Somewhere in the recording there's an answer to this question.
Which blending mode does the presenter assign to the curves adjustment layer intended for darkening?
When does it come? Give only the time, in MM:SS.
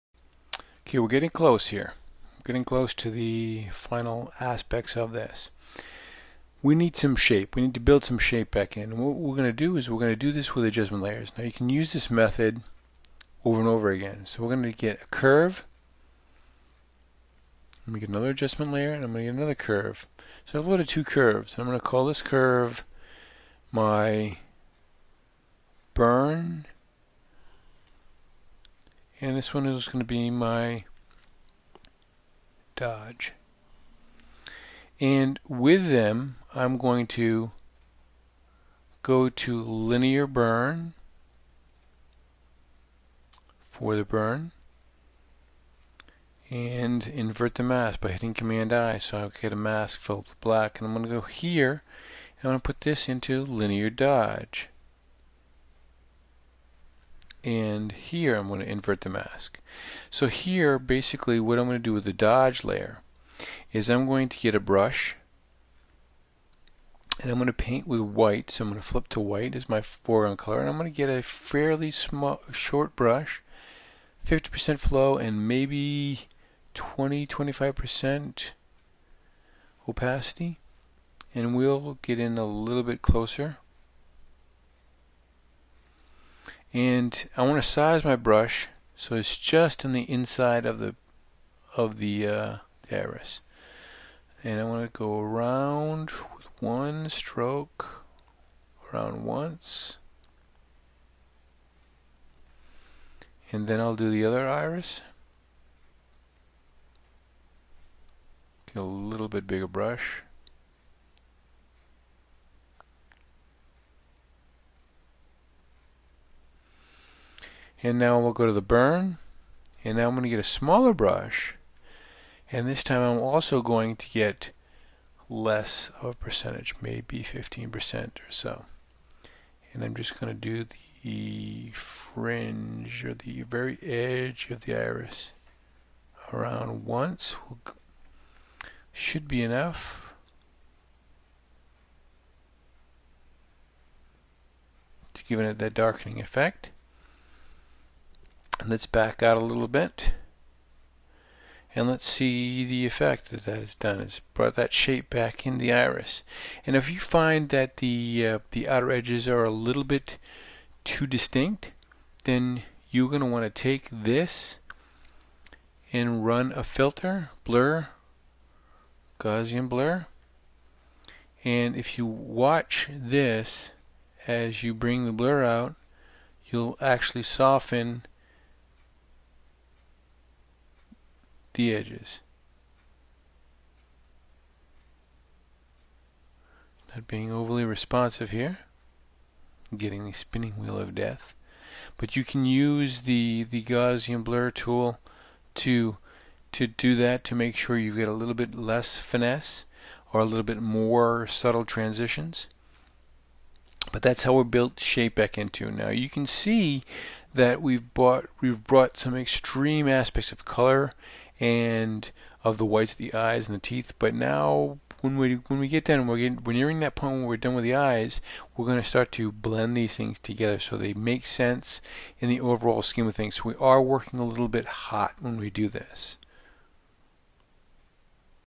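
00:39.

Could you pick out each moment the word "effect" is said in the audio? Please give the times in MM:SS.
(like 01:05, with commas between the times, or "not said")
02:26, 02:32.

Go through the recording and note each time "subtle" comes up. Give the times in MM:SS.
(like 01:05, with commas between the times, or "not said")
03:21.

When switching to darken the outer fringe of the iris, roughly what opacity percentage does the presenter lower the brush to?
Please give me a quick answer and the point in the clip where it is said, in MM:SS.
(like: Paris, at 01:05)
15%, at 02:07.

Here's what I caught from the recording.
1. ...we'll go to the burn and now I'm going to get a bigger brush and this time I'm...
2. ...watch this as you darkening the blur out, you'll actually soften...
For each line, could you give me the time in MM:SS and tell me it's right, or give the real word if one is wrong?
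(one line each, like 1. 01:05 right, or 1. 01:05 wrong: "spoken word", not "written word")
1. 01:58 wrong: "smaller", not "bigger"
2. 02:52 wrong: "bring", not "darkening".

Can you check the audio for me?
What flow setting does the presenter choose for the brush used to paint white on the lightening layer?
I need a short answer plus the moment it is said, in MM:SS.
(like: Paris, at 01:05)
50%, at 01:14.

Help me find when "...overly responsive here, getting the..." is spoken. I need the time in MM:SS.
03:07.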